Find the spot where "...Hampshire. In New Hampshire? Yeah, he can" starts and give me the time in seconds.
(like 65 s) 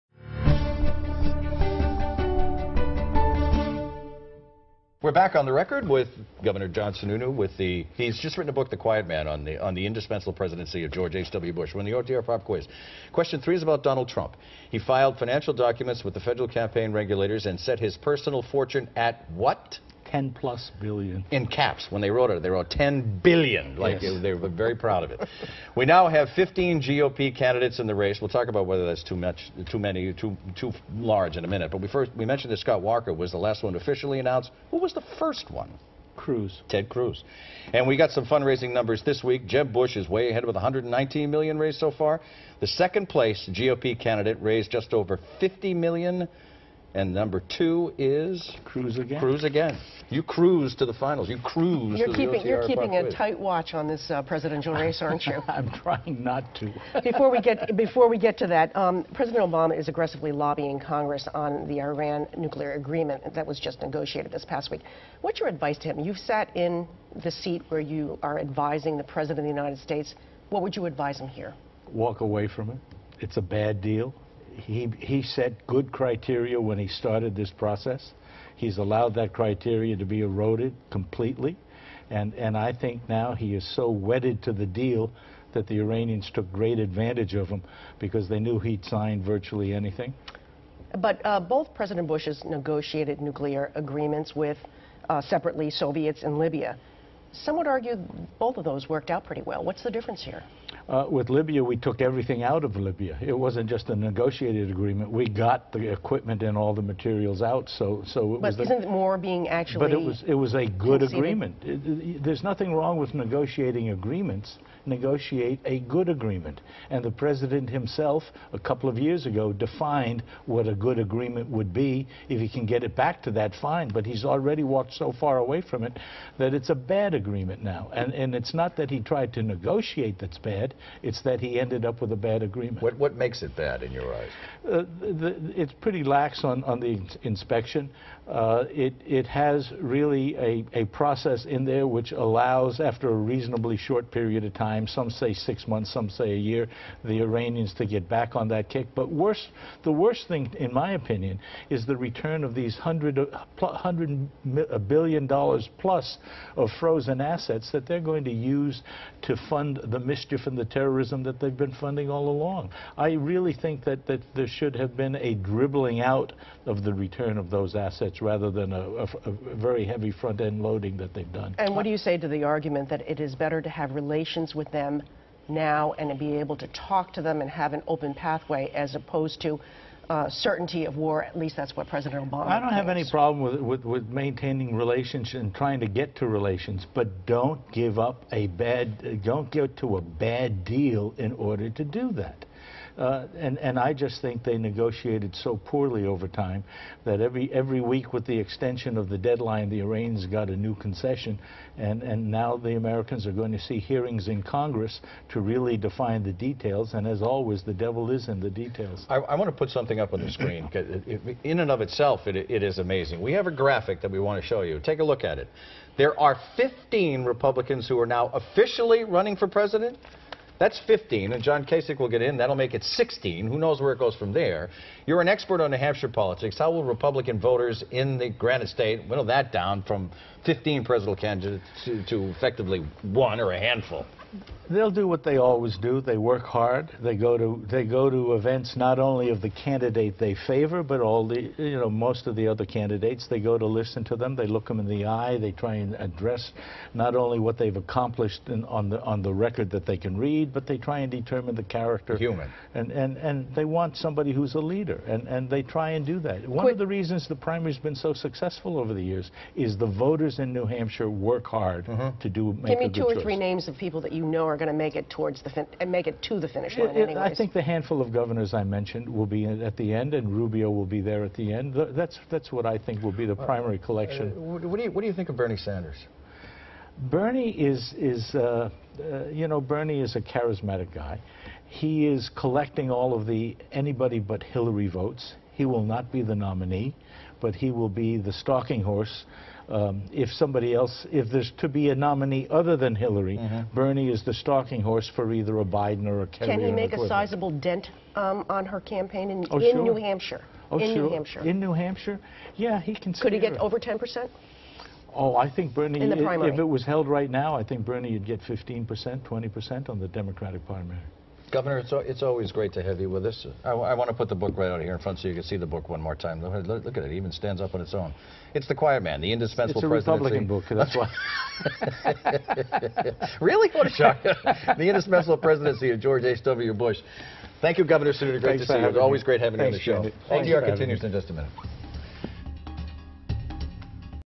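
301 s.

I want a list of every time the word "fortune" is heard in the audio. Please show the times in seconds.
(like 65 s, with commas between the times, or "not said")
18 s.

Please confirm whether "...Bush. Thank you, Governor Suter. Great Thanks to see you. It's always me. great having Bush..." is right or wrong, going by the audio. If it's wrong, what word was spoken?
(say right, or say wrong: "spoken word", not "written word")
wrong: "Thanks", not "Bush".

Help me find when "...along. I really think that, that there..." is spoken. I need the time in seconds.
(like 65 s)
162 s.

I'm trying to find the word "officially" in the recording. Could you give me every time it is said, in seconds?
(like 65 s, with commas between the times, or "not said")
33 s, 218 s.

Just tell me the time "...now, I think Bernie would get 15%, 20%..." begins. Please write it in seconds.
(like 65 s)
307 s.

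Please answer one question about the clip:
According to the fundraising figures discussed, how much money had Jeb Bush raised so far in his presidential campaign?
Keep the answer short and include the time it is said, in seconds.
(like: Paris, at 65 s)
119 million, at 40 s.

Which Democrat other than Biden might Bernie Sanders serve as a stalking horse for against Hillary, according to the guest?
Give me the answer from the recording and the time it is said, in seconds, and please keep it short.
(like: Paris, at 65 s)
Kerry, at 296 s.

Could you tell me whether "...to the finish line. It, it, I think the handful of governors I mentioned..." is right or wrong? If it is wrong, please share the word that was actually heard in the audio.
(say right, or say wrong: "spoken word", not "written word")
right.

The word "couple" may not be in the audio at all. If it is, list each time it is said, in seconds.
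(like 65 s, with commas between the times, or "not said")
118 s.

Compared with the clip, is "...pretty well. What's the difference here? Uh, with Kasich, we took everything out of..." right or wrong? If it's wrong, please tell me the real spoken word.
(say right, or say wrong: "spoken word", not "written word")
wrong: "Libya", not "Kasich".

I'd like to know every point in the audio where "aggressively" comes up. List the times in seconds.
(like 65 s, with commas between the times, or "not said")
59 s.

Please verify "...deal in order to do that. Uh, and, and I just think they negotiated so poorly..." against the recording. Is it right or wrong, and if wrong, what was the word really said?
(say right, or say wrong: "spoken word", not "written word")
right.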